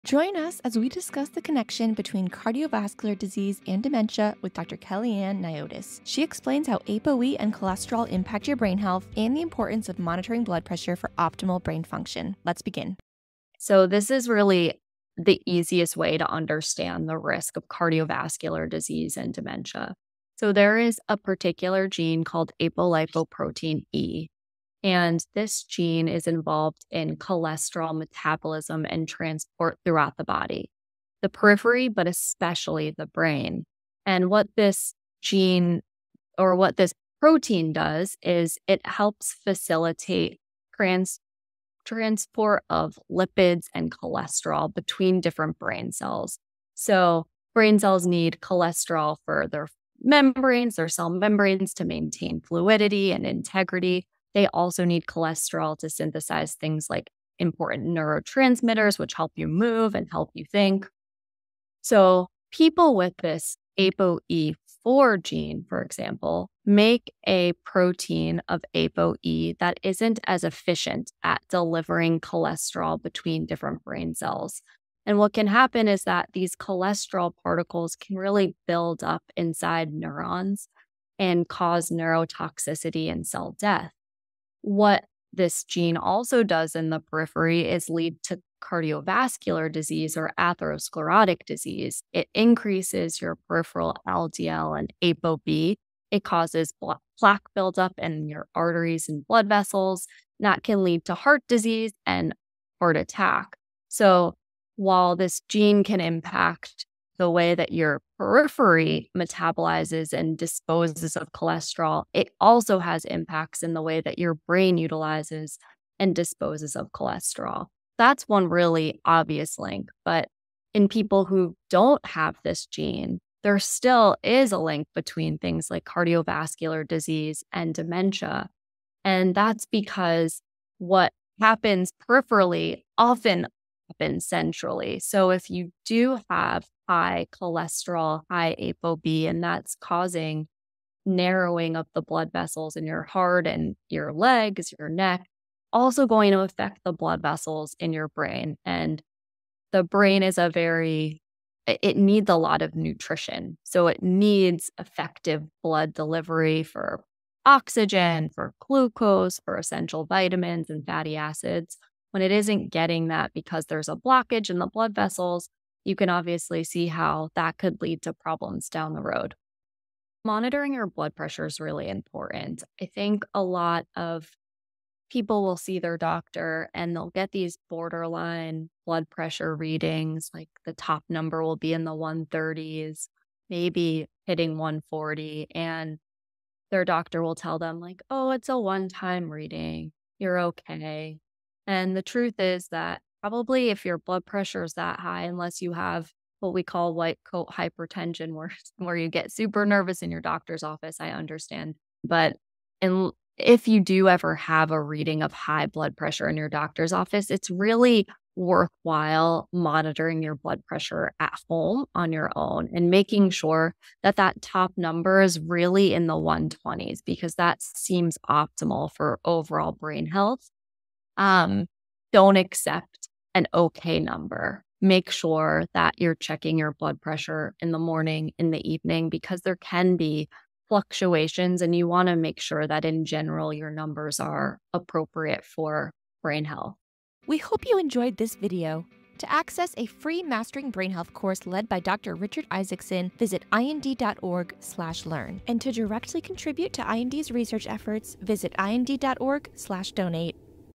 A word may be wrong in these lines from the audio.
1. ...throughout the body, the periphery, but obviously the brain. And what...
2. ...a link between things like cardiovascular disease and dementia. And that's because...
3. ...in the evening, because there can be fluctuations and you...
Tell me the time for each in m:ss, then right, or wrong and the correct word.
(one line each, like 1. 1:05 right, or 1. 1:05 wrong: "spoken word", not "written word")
1. 0:29 wrong: "especially", not "obviously"
2. 2:04 right
3. 3:48 right.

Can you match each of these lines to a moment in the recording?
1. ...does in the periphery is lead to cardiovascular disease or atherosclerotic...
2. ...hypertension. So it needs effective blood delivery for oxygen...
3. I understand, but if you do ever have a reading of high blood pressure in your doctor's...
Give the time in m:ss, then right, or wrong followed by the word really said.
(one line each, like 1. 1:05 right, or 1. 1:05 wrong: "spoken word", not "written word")
1. 1:26 right
2. 2:32 wrong: "nutrition", not "hypertension"
3. 3:20 right.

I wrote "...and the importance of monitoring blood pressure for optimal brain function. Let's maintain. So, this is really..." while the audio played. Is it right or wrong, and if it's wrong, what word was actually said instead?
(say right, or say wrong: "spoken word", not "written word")
wrong: "begin", not "maintain".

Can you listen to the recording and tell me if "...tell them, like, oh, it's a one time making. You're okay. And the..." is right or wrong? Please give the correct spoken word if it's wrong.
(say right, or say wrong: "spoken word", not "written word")
wrong: "reading", not "making".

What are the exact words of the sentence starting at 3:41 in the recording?
Um, don't accept an okay number.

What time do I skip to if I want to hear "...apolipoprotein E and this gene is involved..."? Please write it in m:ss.
0:22.